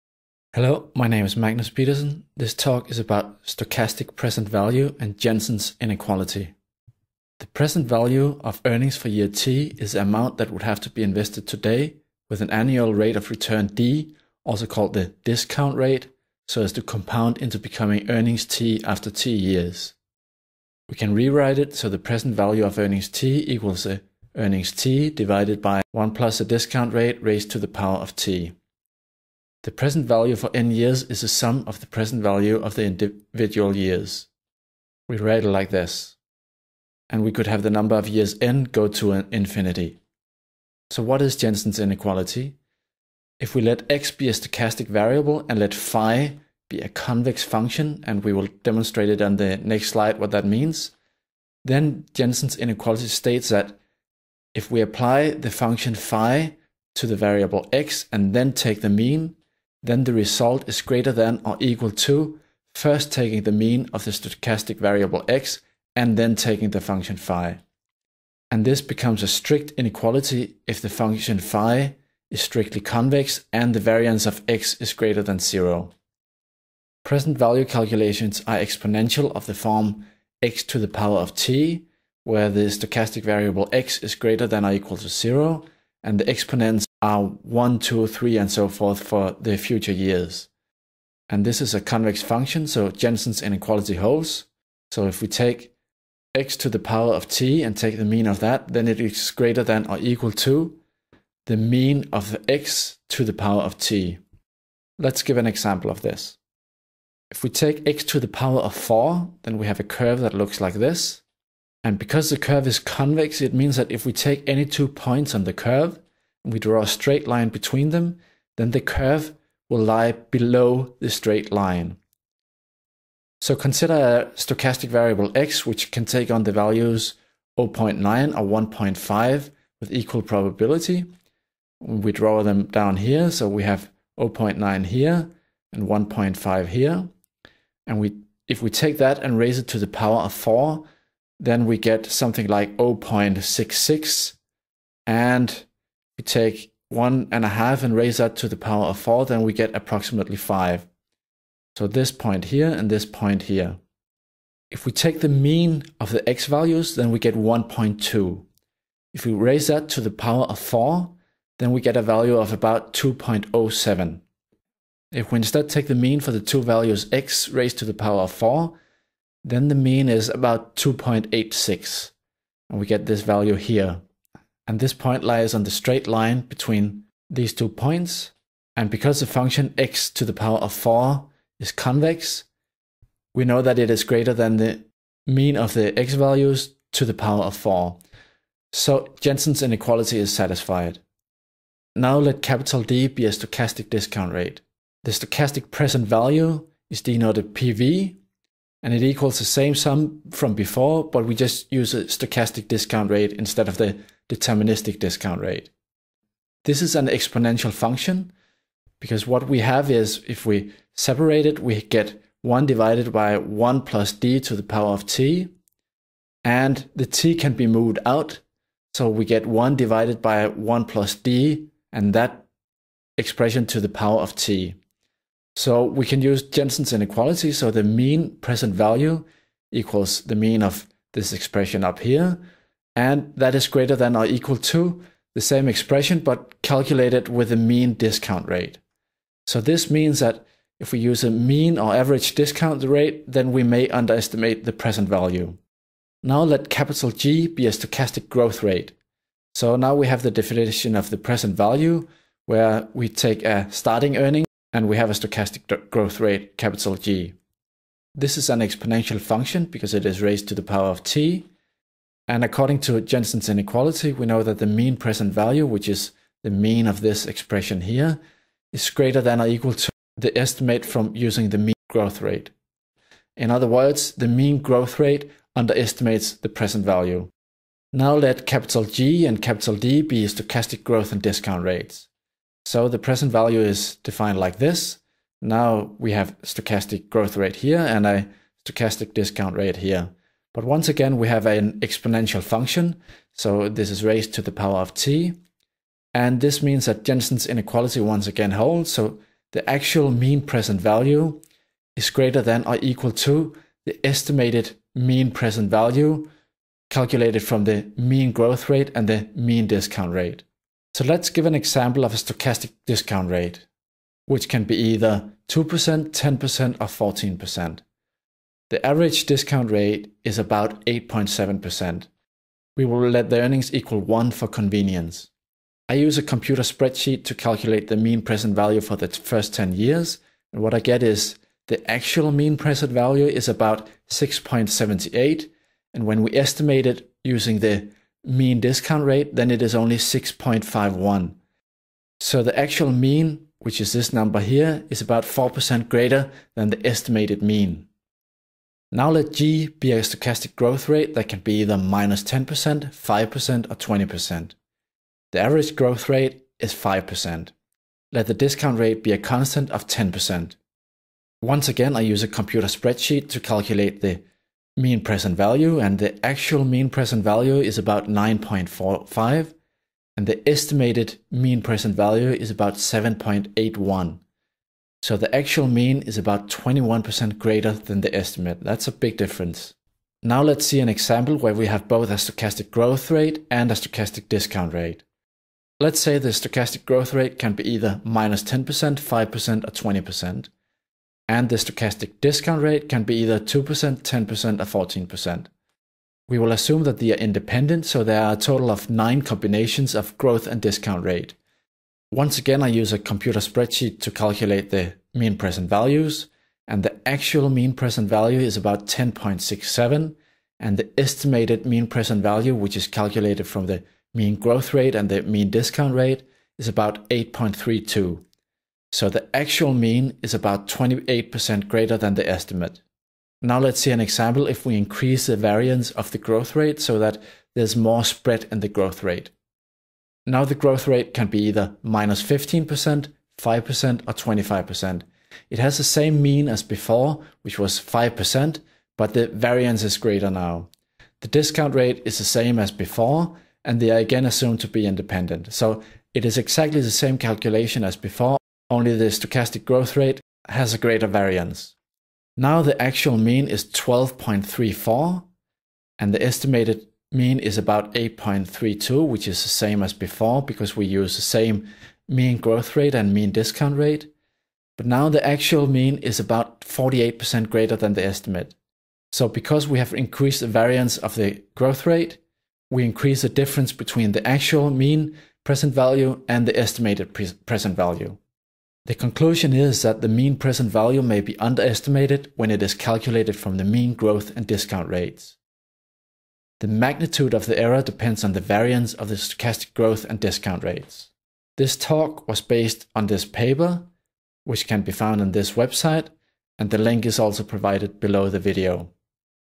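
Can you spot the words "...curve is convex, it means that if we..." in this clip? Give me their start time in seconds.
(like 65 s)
112 s.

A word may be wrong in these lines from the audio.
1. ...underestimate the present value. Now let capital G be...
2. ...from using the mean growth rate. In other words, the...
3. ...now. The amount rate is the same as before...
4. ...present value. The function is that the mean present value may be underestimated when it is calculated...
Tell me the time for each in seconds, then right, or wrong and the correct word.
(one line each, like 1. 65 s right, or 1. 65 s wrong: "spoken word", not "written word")
1. 243 s right
2. 270 s right
3. 440 s wrong: "discount", not "amount"
4. 477 s wrong: "conclusion", not "function".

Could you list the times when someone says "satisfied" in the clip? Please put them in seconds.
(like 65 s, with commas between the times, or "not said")
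190 s.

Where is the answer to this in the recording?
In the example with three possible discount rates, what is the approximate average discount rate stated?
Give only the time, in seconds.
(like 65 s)
320 s.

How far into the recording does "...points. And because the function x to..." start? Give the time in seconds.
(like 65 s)
177 s.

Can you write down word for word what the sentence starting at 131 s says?
We draw them down here, so we have 0.9 here and 1.5 here.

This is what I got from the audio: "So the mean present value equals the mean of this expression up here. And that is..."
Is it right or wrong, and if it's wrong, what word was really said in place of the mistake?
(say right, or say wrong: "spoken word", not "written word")
right.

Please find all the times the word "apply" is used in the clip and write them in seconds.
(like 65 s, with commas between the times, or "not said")
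54 s.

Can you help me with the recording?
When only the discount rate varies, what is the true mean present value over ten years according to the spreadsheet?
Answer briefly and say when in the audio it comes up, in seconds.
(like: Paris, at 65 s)
6.78, at 334 s.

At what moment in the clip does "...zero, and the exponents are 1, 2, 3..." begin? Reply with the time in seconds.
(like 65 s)
85 s.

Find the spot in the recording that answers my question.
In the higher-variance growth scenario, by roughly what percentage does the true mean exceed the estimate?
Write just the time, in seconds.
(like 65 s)
466 s.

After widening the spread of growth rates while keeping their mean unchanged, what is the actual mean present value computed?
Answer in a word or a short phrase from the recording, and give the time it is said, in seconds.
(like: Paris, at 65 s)
12.34, at 453 s.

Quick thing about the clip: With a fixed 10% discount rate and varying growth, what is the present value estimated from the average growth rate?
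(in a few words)
7.81.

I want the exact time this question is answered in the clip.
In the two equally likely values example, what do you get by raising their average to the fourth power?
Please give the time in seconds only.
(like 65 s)
162 s.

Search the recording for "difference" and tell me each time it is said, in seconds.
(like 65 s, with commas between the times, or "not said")
379 s, 473 s.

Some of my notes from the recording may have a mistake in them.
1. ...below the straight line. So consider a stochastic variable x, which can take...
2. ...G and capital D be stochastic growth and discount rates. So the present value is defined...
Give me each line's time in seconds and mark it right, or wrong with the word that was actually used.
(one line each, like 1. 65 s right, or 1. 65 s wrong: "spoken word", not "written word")
1. 120 s right
2. 278 s right.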